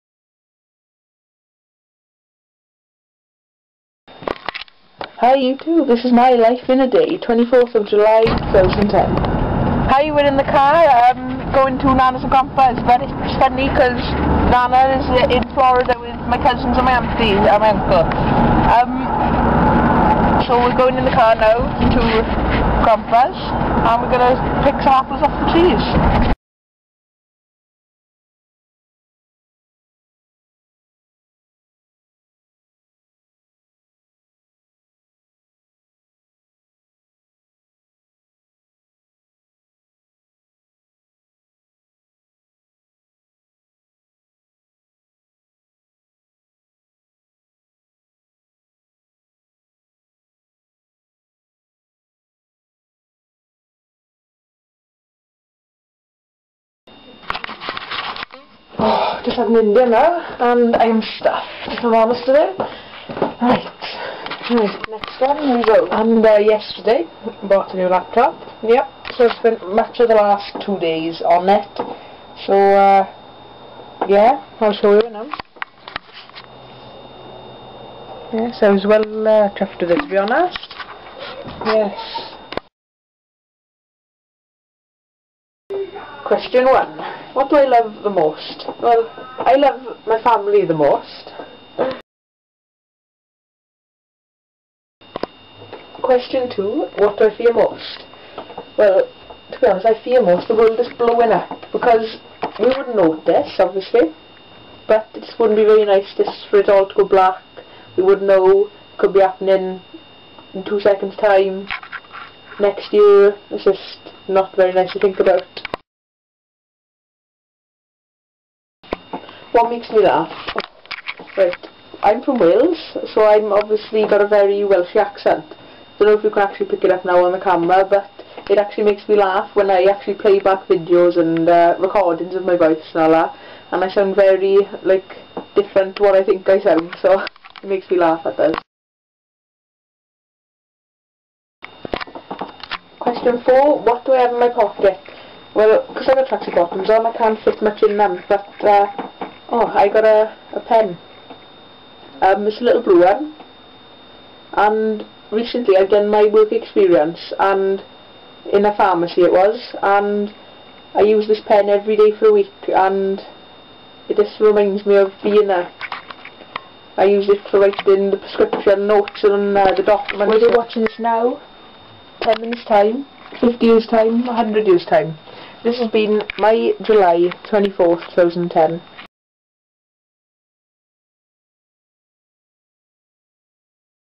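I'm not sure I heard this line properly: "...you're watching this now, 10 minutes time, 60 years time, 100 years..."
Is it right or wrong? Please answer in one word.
wrong.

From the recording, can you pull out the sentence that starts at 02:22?
Question 4, what do I have in my pocket?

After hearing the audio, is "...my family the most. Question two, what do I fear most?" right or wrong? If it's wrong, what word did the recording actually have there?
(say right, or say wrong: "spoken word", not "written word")
right.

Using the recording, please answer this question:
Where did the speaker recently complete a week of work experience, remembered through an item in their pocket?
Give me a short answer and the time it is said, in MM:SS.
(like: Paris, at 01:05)
A pharmacy, at 02:38.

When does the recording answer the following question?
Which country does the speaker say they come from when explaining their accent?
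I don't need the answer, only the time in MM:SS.
02:02.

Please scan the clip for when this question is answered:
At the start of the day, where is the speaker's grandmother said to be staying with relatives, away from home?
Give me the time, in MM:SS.
00:15.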